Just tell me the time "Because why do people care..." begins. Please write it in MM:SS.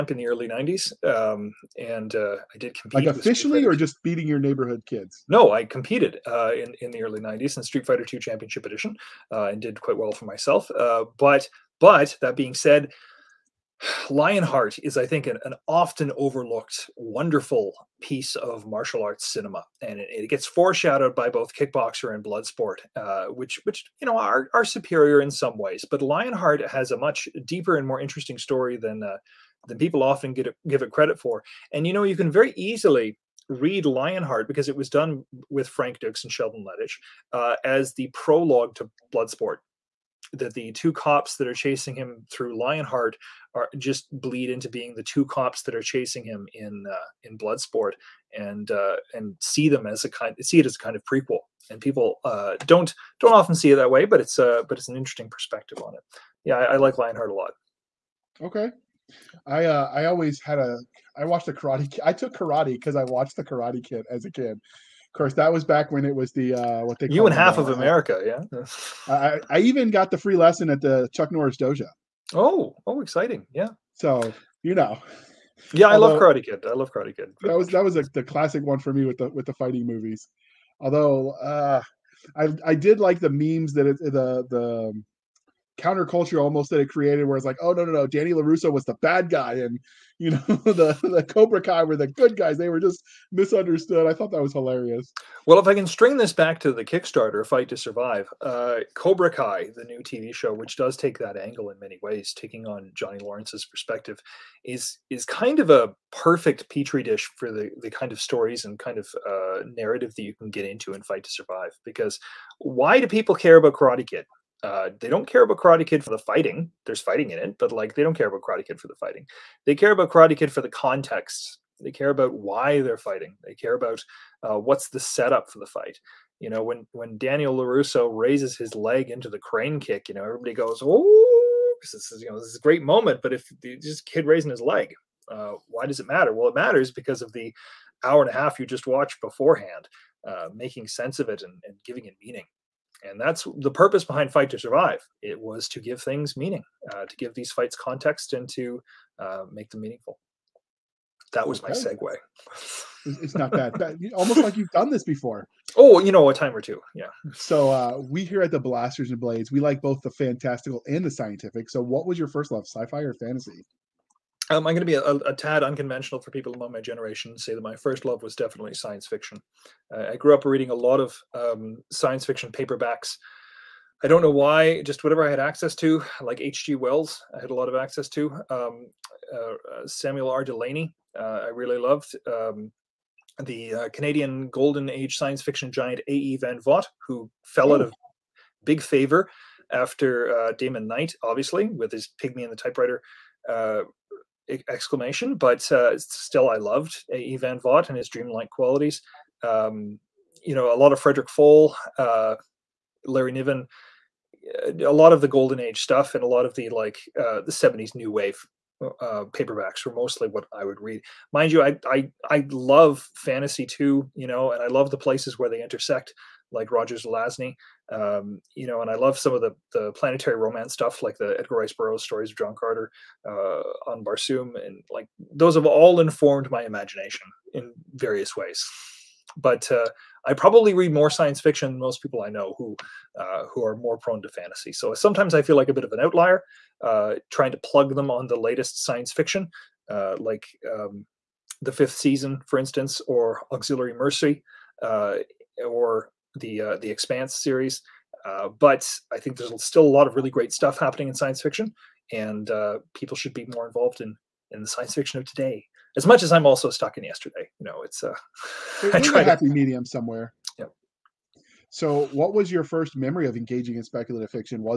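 01:51.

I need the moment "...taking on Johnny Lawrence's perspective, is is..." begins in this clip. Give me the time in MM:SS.
01:42.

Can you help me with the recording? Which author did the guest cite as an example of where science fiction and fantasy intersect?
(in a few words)
Roger Zelazny.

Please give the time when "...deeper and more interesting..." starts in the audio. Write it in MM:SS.
00:27.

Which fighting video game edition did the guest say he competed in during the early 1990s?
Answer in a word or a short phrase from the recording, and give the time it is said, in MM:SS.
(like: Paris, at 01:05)
Street Fighter II Championship Edition, at 00:07.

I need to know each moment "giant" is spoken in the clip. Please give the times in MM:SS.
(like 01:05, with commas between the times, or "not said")
03:05.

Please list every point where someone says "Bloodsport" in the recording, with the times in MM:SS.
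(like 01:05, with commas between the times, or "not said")
00:22, 00:39, 00:47.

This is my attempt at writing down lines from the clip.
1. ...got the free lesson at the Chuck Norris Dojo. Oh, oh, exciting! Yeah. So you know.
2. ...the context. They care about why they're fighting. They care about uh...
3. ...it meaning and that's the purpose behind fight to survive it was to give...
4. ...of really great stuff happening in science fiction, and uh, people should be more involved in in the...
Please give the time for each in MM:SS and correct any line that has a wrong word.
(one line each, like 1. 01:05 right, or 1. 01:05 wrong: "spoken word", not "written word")
1. 01:09 right
2. 02:00 right
3. 02:22 right
4. 04:10 right.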